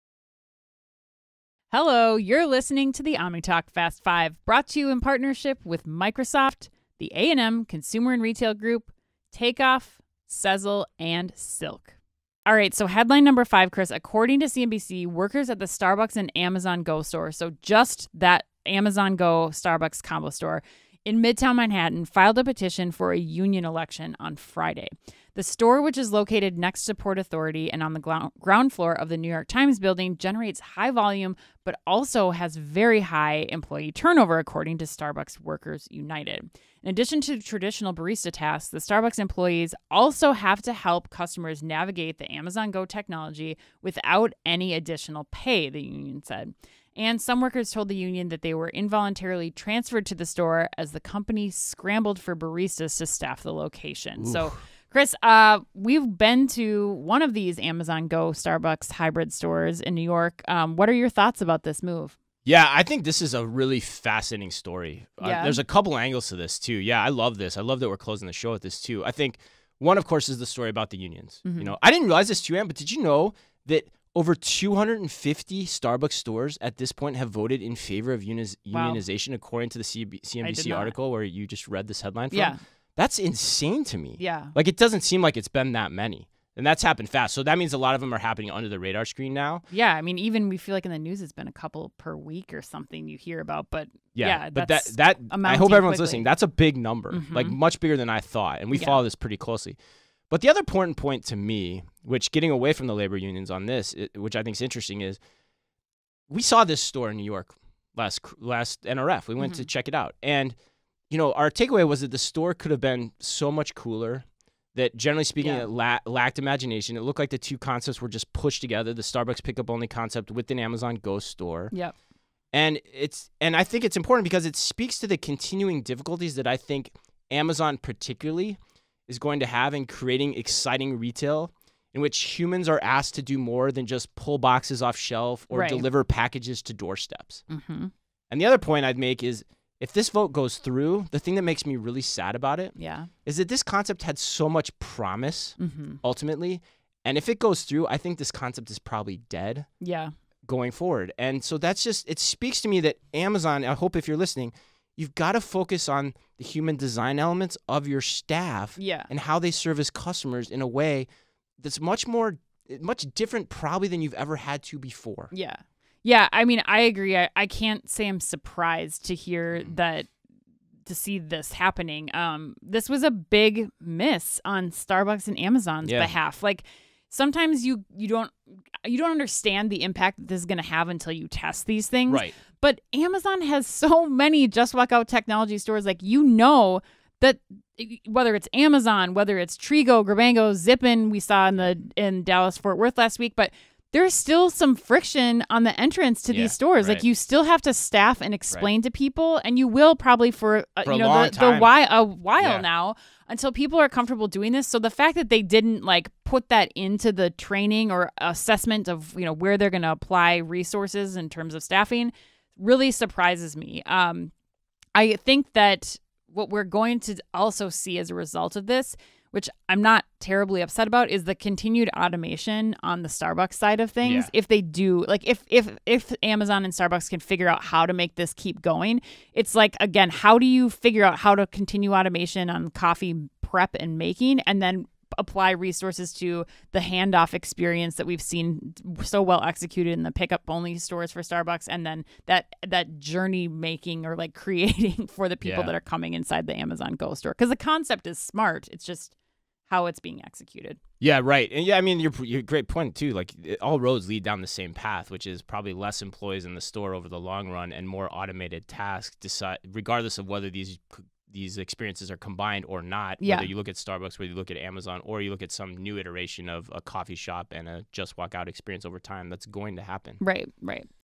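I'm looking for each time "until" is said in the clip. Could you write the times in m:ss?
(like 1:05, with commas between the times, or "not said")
3:00, 3:23.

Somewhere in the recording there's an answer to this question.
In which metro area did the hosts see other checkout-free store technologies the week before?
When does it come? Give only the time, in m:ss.
3:12.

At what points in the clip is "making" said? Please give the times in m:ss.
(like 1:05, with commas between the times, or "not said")
3:53, 4:03.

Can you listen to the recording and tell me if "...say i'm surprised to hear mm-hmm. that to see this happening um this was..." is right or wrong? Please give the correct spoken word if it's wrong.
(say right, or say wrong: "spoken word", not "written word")
right.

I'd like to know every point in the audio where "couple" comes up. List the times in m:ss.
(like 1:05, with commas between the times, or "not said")
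1:05, 1:31.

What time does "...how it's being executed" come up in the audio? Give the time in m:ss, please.
4:09.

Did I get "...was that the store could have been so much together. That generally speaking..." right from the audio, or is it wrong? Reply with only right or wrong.
wrong.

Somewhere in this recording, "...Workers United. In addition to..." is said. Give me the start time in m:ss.
0:35.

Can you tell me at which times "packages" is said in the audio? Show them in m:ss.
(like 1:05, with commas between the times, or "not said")
2:16.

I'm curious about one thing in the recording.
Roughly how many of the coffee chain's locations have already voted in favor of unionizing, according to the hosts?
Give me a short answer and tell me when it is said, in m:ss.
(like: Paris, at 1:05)
250, at 1:14.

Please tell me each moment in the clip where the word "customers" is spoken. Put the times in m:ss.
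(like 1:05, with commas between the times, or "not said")
0:41, 2:39.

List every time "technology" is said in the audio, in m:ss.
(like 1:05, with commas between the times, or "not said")
0:42, 3:05.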